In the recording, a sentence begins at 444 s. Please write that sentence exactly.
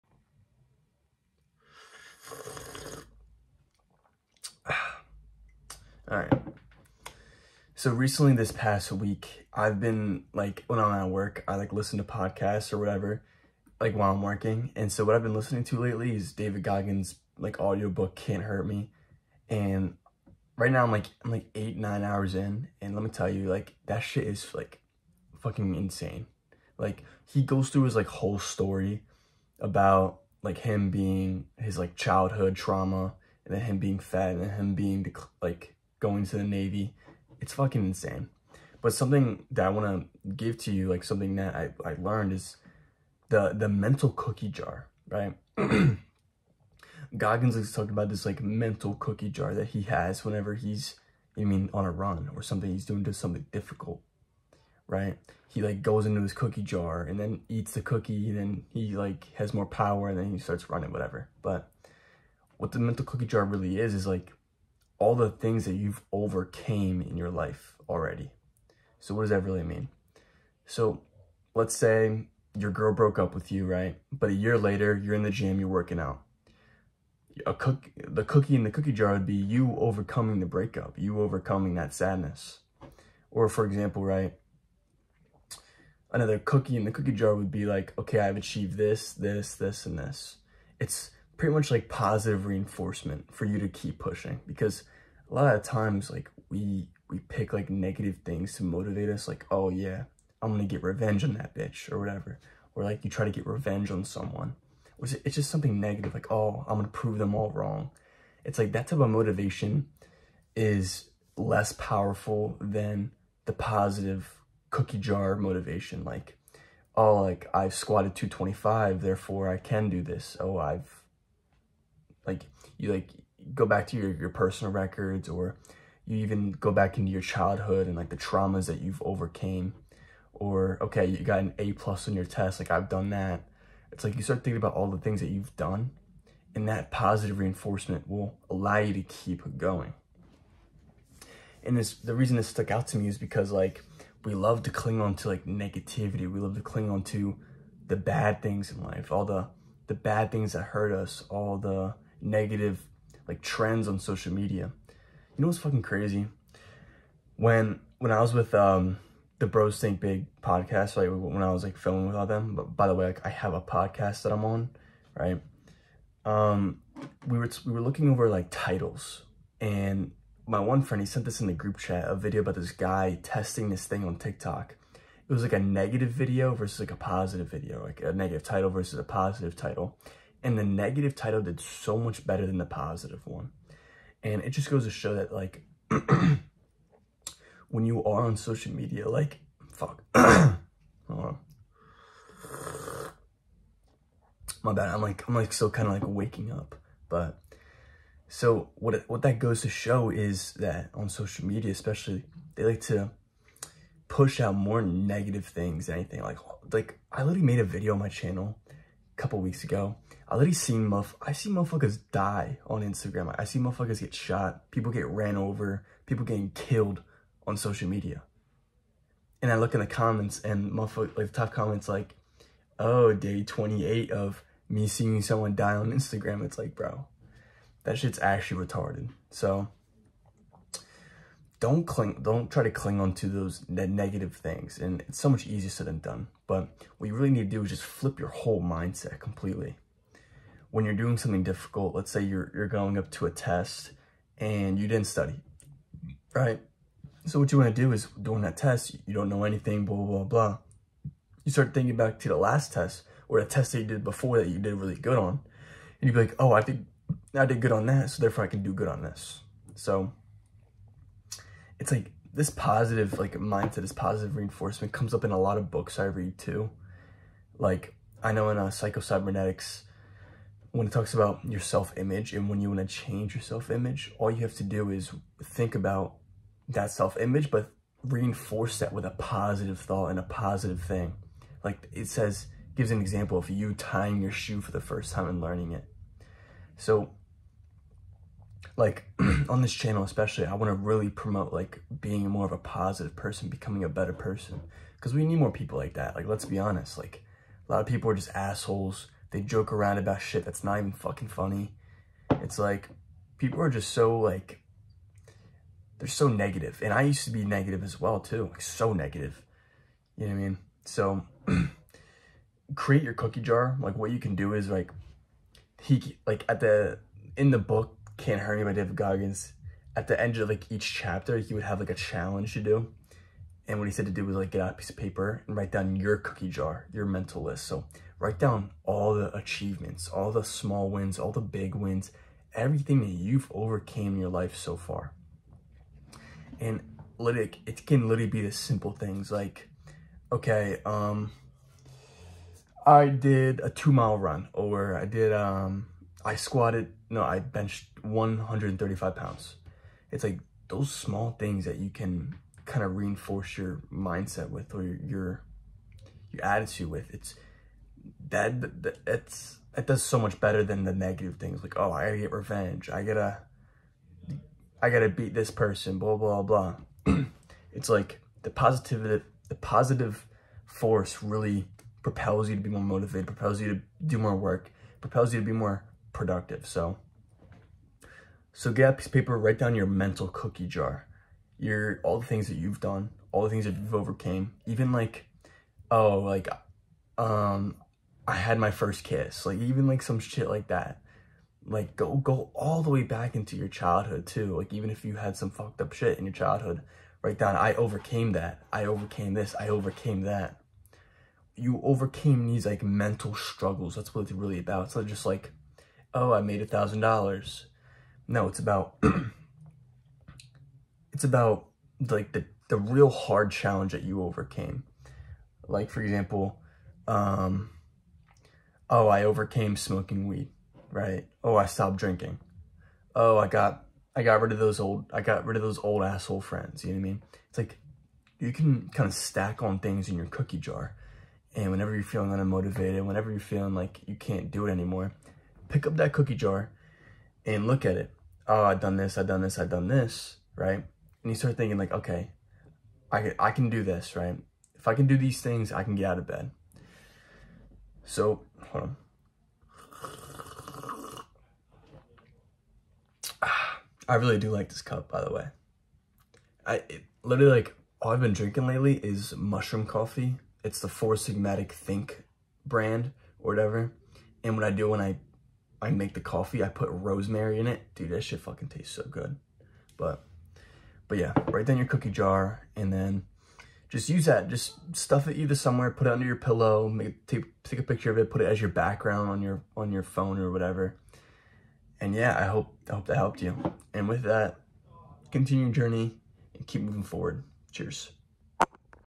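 If I can do these things, I can get out of bed.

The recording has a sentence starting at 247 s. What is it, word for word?
So what you want to do is during that test, you don't know anything, blah, blah, blah, blah.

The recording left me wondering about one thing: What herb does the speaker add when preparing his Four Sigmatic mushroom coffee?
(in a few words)
rosemary.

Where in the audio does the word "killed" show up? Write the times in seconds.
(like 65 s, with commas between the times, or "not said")
216 s.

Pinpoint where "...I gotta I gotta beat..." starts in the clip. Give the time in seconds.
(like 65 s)
362 s.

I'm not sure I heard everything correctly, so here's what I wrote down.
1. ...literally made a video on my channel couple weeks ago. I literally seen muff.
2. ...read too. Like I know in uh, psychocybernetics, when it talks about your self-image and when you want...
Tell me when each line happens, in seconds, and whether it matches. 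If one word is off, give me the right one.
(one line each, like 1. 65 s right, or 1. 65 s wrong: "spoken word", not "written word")
1. 207 s right
2. 266 s right.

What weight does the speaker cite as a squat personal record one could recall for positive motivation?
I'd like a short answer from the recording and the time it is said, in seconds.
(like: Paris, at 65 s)
225, at 118 s.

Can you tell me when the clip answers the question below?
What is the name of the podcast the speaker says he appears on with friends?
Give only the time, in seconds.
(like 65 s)
159 s.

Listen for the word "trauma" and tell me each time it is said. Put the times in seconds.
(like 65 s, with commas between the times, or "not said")
32 s, 128 s.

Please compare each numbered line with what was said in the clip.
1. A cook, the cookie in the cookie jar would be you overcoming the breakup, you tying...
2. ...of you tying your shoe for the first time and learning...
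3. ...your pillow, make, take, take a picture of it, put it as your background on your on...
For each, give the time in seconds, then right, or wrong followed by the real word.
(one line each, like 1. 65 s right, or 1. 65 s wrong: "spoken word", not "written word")
1. 77 s wrong: "overcoming", not "tying"
2. 283 s right
3. 476 s right.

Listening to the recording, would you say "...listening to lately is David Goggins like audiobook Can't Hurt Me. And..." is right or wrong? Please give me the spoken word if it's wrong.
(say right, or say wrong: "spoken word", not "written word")
right.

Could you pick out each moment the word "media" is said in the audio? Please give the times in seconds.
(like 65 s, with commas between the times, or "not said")
154 s, 188 s, 201 s, 217 s.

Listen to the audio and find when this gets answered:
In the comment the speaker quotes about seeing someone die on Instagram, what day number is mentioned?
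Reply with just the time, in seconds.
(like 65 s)
223 s.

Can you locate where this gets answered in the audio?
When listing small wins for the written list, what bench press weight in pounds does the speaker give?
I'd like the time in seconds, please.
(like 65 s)
348 s.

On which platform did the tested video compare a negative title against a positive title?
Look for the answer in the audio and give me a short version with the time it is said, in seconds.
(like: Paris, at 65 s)
TikTok, at 174 s.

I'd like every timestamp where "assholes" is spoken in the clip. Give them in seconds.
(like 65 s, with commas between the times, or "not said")
298 s, 426 s.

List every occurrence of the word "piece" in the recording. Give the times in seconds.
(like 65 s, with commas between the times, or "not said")
324 s, 378 s.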